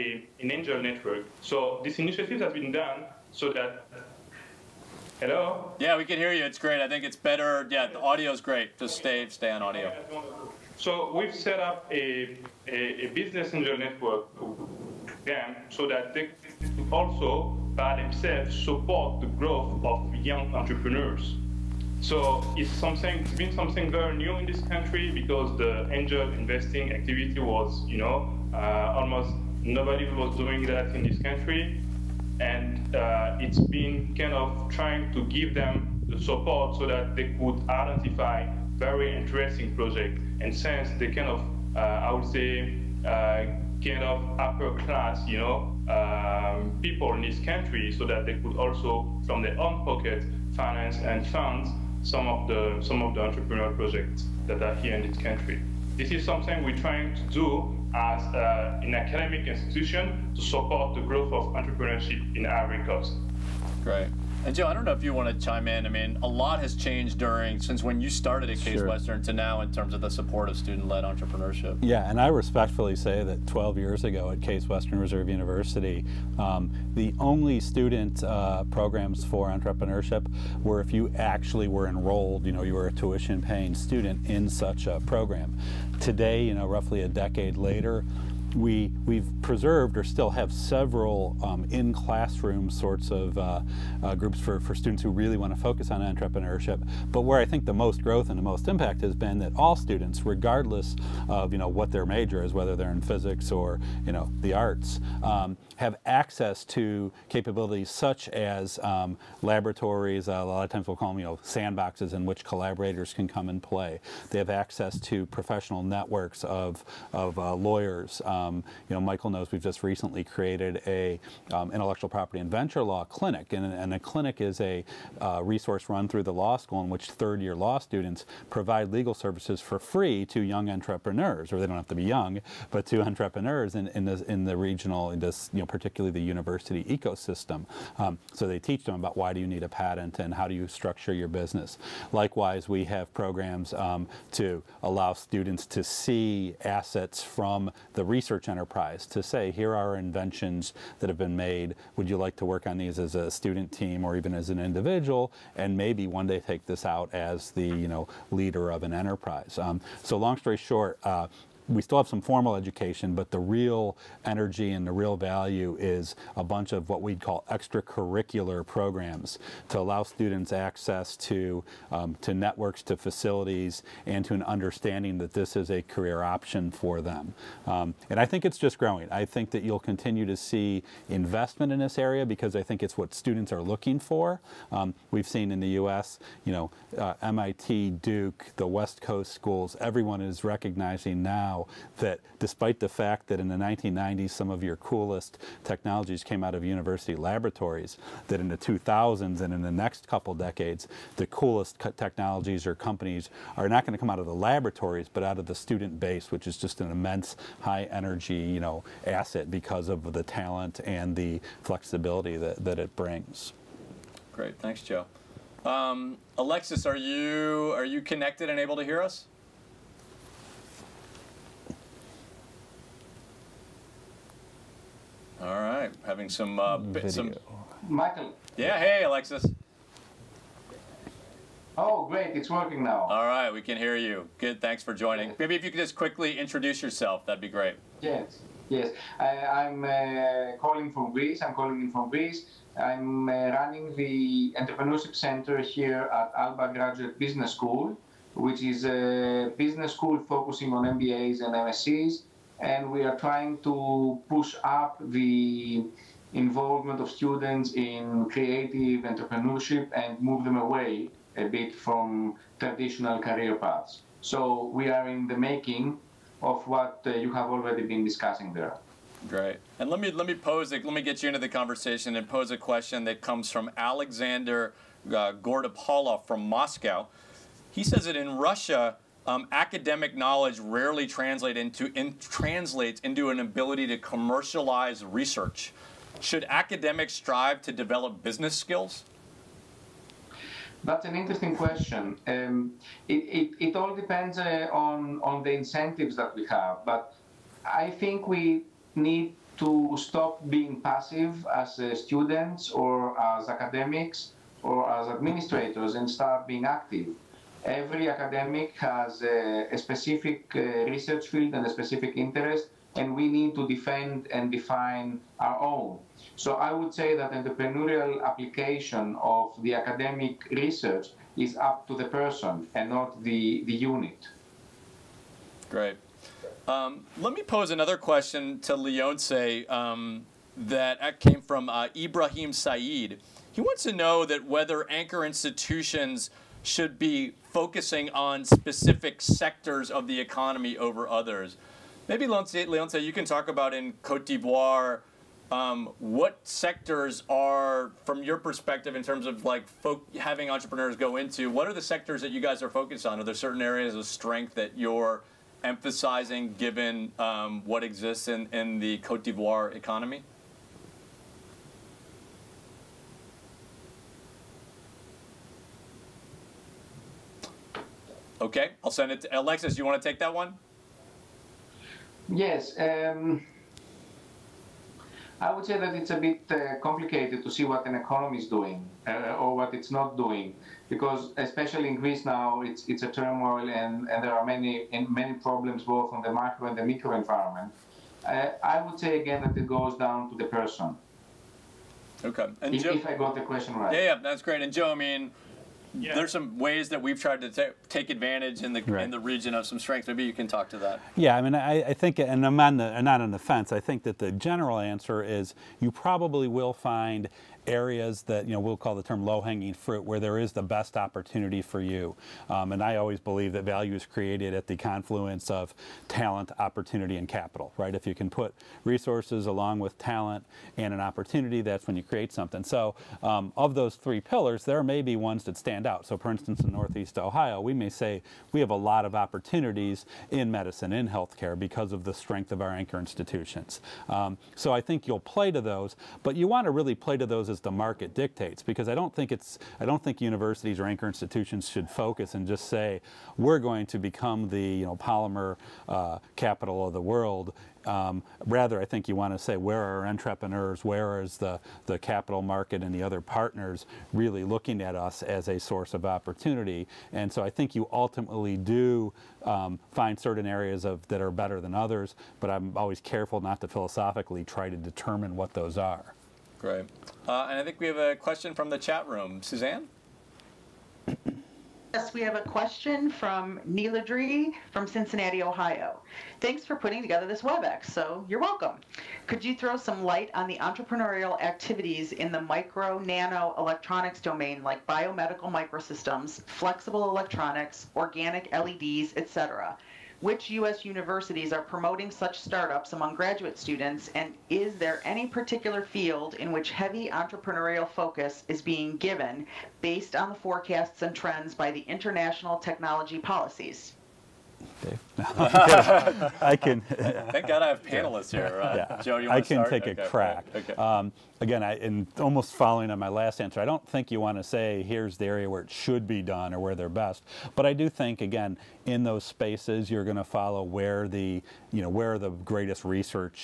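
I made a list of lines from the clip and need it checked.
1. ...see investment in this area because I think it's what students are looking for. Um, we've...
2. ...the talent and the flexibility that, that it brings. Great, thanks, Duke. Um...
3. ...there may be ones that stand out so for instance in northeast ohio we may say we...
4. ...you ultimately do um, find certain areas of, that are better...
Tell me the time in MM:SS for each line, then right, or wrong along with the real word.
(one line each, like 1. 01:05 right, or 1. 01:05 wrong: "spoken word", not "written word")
1. 03:00 right
2. 03:30 wrong: "Joe", not "Duke"
3. 07:04 right
4. 07:37 right.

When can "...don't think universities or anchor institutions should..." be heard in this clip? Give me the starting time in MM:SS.
07:19.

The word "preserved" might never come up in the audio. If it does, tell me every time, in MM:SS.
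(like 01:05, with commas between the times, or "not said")
01:29.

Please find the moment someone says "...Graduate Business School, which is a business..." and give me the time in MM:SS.
04:06.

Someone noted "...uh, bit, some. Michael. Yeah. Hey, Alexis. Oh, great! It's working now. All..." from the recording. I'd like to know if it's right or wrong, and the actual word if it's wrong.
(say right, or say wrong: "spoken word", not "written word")
right.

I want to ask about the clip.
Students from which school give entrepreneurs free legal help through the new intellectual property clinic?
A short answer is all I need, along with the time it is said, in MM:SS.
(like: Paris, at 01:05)
law school, at 02:06.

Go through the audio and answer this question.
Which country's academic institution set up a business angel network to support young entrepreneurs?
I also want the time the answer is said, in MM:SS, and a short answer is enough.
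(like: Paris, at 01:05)
Ivory Coast, at 01:02.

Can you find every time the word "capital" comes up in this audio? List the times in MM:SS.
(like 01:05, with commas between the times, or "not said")
06:57, 07:26, 07:31.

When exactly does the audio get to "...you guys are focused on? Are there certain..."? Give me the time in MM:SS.
05:52.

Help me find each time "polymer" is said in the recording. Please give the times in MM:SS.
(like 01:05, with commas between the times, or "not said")
07:24.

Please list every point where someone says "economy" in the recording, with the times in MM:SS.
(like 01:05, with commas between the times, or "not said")
05:40, 05:59, 06:17.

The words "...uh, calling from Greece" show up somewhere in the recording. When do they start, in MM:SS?
03:59.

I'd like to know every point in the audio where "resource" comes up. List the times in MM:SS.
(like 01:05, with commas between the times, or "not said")
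02:05, 06:58.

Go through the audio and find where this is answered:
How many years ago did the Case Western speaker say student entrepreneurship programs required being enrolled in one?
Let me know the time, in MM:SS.
01:13.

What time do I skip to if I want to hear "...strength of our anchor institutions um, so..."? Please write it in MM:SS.
07:12.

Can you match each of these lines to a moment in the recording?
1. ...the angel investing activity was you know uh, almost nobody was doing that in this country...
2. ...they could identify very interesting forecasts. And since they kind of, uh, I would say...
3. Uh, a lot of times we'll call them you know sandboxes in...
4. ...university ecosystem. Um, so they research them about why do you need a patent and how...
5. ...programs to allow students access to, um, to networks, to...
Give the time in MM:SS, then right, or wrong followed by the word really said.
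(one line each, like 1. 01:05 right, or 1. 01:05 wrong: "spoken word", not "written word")
1. 00:25 right
2. 00:37 wrong: "projects", not "forecasts"
3. 01:50 right
4. 02:16 wrong: "teach", not "research"
5. 02:48 right.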